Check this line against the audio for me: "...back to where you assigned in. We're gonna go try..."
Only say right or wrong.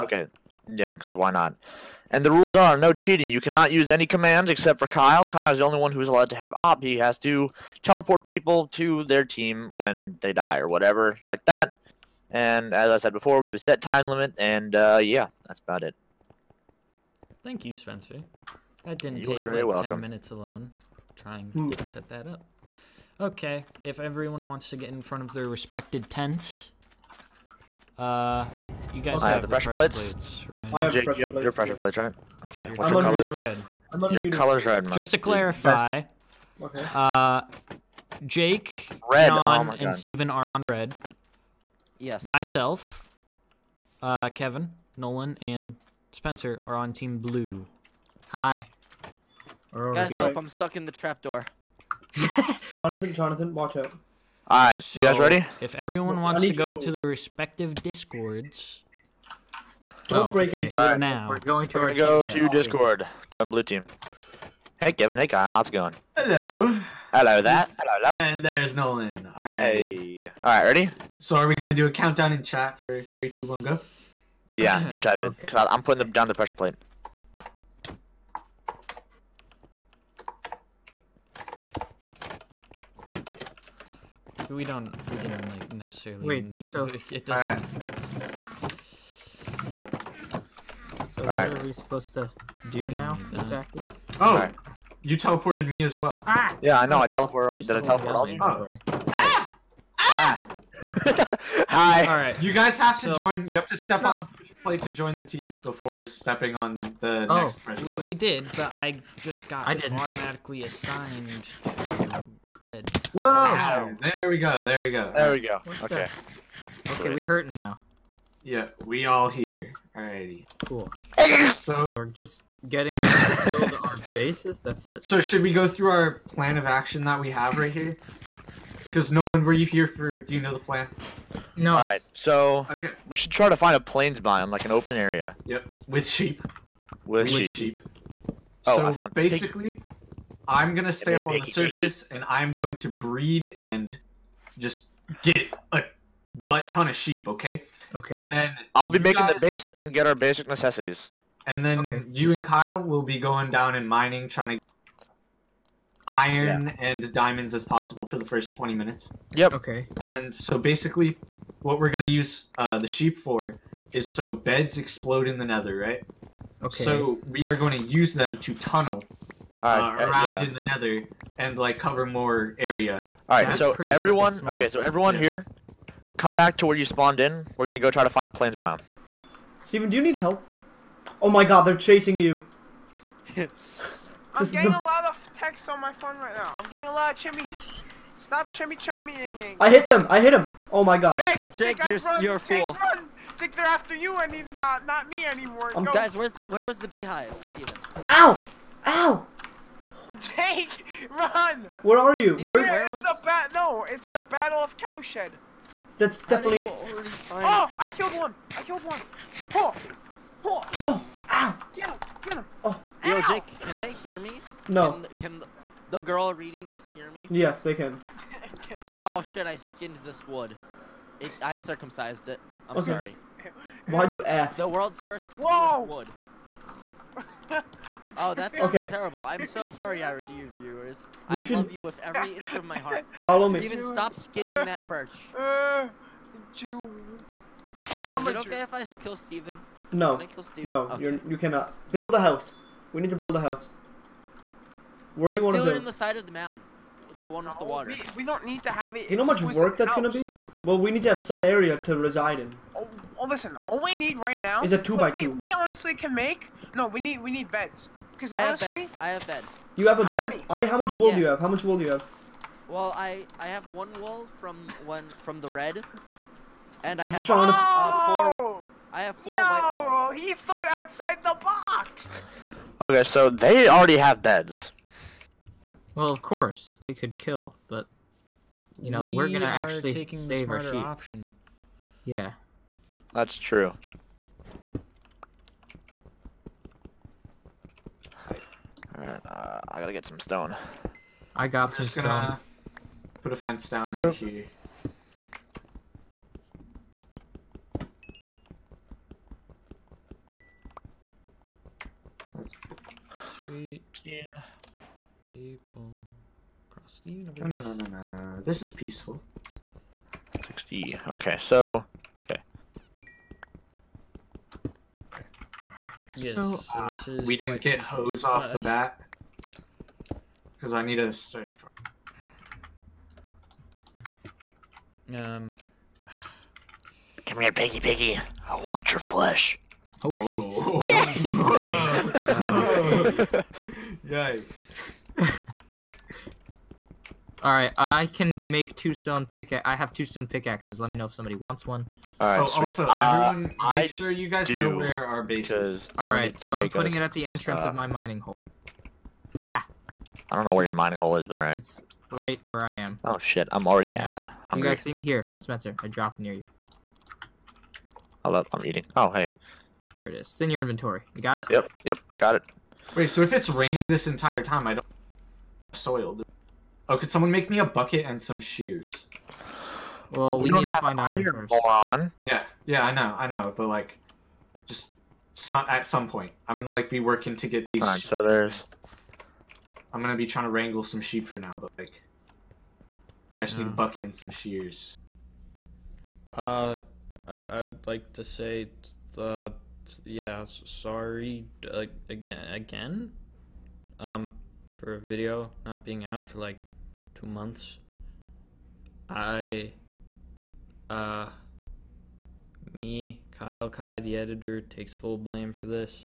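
wrong.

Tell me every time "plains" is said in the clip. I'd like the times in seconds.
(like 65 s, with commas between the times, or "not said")
133 s, 178 s.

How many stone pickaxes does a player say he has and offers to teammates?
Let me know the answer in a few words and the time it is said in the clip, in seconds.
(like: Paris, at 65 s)
2, at 339 s.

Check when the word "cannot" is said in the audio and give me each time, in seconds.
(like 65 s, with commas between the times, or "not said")
3 s, 241 s.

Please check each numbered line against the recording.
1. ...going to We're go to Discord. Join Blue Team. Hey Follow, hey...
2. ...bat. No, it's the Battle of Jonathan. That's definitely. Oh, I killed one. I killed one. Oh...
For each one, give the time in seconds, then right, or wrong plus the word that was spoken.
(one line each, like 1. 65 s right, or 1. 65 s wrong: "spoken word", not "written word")
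1. 61 s wrong: "Kevin", not "Follow"
2. 203 s wrong: "Cowshed", not "Jonathan".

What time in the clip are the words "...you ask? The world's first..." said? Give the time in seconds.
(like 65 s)
224 s.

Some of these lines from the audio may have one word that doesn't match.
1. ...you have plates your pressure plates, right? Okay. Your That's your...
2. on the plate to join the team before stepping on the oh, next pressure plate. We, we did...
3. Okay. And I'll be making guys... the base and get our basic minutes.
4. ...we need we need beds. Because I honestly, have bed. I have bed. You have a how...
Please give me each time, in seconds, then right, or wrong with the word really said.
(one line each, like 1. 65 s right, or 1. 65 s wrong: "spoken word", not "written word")
1. 31 s wrong: "What", not "That"
2. 104 s right
3. 147 s wrong: "necessities", not "minutes"
4. 256 s right.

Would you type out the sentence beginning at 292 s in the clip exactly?
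Gonna put a fence down right here.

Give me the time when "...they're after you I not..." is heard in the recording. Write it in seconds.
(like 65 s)
193 s.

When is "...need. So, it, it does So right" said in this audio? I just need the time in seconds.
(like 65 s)
86 s.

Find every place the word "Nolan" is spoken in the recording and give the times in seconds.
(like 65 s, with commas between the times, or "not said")
44 s, 68 s, 129 s.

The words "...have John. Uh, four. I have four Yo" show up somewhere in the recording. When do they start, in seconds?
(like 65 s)
267 s.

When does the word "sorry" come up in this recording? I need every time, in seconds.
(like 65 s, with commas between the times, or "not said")
222 s, 229 s, 390 s.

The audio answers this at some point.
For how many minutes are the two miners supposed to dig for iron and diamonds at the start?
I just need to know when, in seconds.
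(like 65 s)
158 s.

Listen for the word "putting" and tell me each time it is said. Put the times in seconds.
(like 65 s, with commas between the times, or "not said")
75 s, 346 s.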